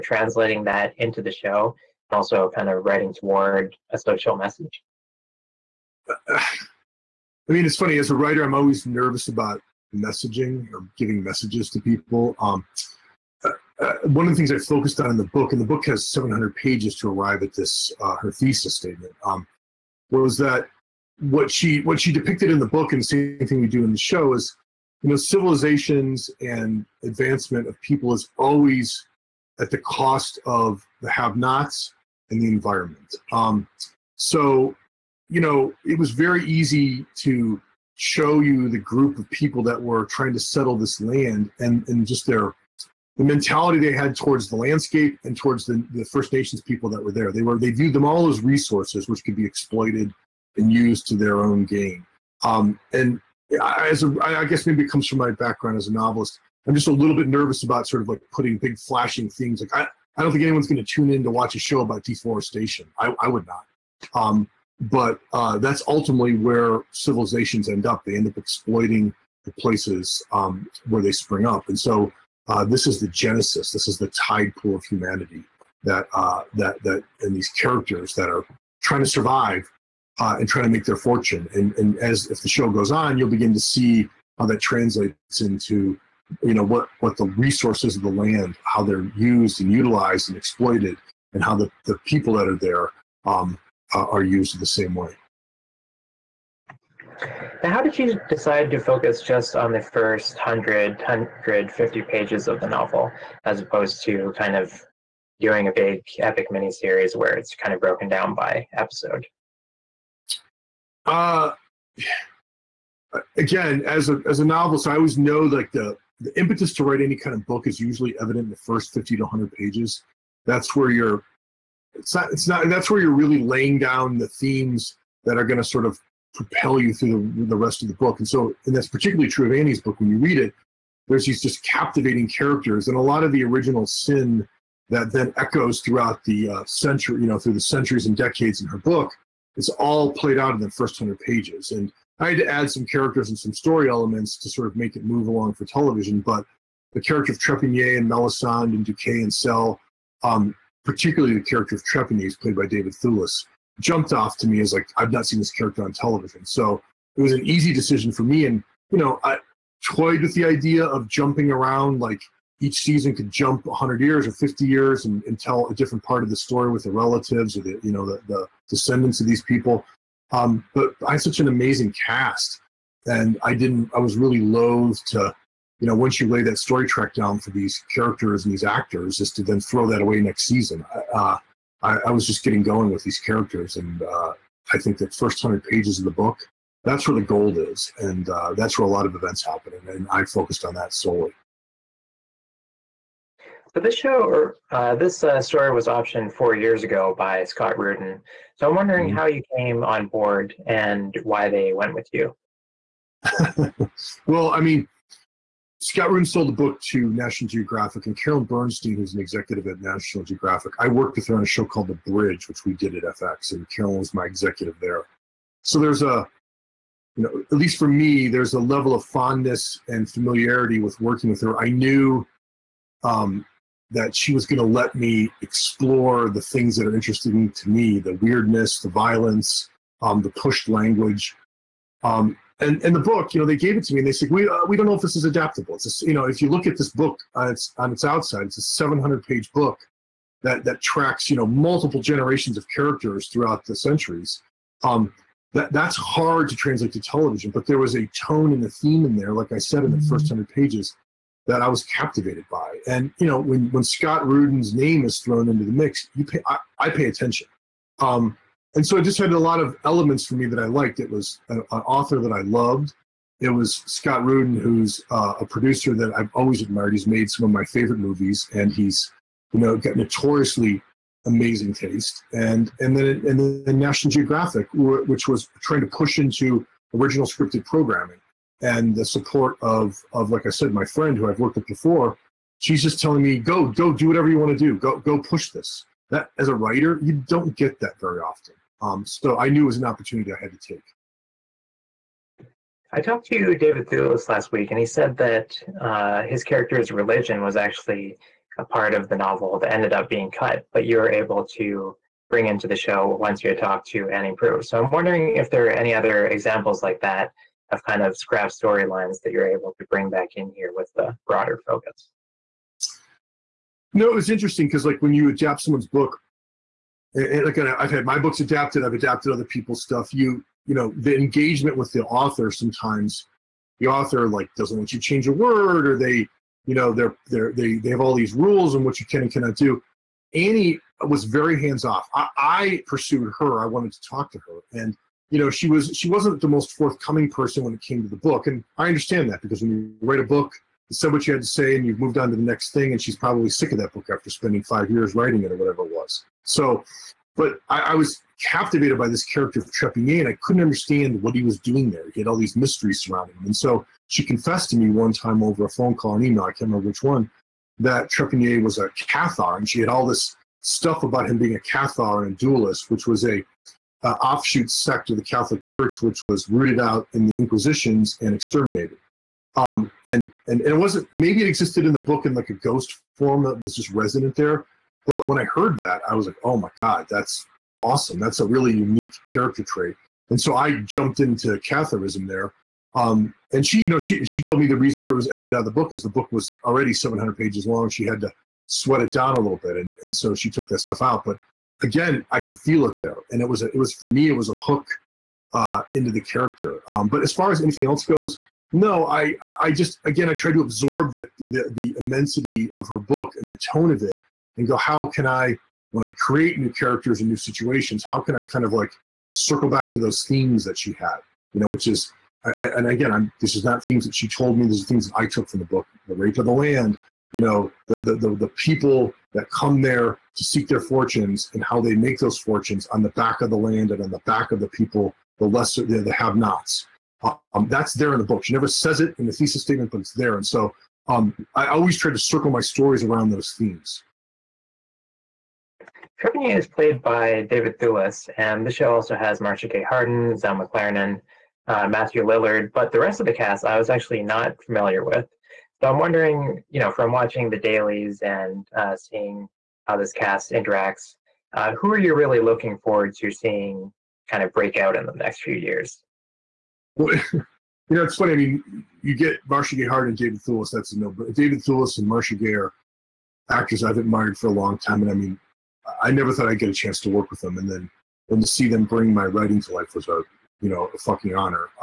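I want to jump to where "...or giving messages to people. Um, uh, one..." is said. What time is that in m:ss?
0:10.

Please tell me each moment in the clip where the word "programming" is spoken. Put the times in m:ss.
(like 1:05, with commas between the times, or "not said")
4:37.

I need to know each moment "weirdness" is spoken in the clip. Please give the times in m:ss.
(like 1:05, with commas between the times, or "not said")
3:48.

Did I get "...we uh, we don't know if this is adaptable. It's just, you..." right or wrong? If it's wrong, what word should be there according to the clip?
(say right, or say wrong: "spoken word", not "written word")
right.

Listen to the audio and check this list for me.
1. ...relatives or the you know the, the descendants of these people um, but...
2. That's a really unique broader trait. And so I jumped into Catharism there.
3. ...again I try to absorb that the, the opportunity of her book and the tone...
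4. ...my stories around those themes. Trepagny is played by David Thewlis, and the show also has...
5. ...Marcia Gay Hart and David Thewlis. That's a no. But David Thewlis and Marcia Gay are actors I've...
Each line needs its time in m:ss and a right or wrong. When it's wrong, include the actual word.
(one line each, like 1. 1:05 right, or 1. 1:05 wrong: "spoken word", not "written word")
1. 2:46 right
2. 6:18 wrong: "character", not "broader"
3. 6:40 wrong: "immensity", not "opportunity"
4. 7:12 right
5. 7:39 right.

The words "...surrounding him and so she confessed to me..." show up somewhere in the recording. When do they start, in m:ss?
5:53.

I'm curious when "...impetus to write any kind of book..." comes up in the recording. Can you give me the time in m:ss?
1:56.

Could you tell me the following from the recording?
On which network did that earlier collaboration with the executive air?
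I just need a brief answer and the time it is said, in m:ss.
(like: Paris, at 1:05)
FX, at 3:33.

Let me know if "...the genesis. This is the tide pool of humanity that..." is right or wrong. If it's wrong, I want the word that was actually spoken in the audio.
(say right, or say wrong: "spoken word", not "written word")
right.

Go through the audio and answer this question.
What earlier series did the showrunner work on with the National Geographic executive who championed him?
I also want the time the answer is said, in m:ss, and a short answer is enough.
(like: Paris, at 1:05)
The Bridge, at 3:31.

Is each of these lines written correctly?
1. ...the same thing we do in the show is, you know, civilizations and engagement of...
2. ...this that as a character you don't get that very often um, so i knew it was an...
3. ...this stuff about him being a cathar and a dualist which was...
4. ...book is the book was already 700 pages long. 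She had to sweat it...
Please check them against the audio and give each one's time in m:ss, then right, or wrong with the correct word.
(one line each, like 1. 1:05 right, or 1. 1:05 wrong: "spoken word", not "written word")
1. 0:23 wrong: "advancement", not "engagement"
2. 4:45 wrong: "writer", not "character"
3. 6:00 right
4. 6:25 right.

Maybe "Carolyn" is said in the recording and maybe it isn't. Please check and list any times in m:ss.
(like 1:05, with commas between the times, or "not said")
3:28, 3:33.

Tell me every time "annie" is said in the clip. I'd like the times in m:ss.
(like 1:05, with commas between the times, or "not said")
2:09, 5:04, 5:30.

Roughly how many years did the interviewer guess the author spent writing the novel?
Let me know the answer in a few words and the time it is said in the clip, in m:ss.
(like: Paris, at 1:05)
5, at 5:44.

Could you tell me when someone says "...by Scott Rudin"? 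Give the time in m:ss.
3:17.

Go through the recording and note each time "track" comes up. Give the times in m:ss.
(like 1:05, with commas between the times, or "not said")
2:56, 4:00.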